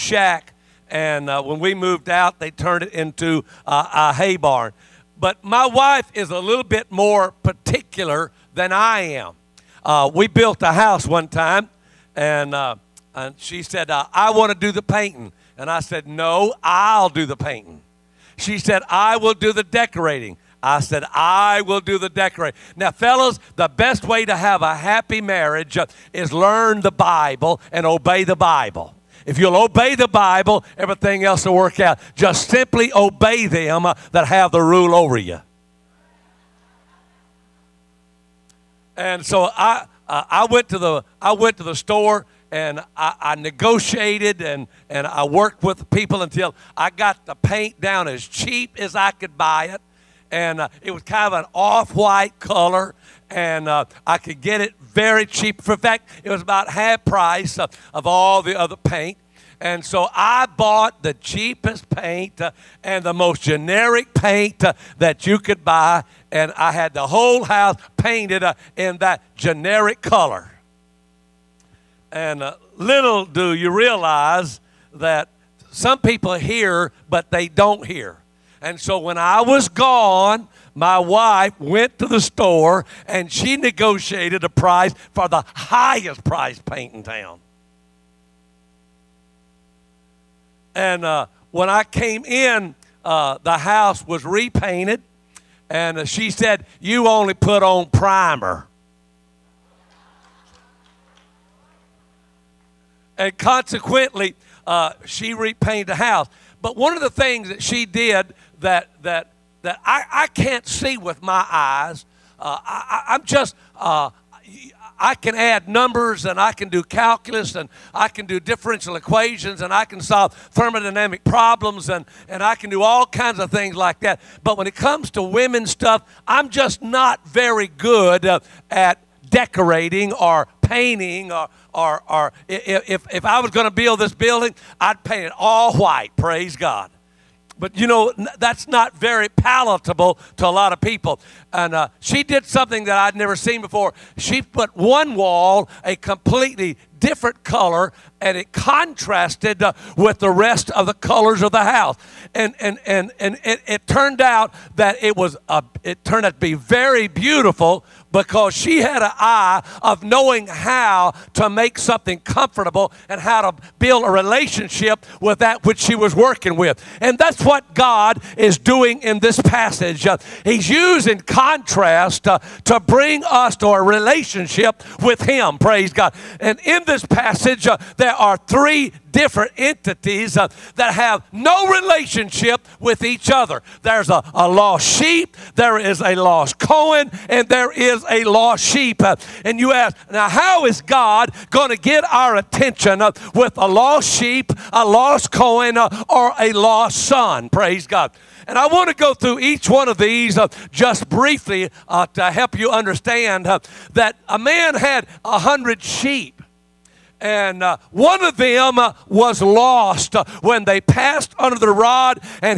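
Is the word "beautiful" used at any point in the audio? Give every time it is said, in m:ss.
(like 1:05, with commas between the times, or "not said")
2:37.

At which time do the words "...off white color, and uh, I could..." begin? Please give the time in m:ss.
0:51.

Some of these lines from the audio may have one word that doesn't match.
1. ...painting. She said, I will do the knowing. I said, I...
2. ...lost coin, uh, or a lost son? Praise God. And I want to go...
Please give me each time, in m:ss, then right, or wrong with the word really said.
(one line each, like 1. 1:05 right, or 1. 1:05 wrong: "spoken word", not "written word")
1. 0:17 wrong: "decorating", not "knowing"
2. 3:14 right.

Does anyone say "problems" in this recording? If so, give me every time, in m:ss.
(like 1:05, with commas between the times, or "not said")
2:01.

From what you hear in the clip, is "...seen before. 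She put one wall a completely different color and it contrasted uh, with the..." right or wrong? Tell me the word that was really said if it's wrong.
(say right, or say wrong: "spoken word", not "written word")
right.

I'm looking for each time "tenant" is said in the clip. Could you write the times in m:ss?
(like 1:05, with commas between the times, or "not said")
not said.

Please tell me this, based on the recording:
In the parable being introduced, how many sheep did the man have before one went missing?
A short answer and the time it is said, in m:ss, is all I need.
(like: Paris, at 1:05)
100, at 3:25.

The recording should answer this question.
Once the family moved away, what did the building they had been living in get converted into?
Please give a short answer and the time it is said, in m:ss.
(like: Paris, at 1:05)
a hay barn, at 0:03.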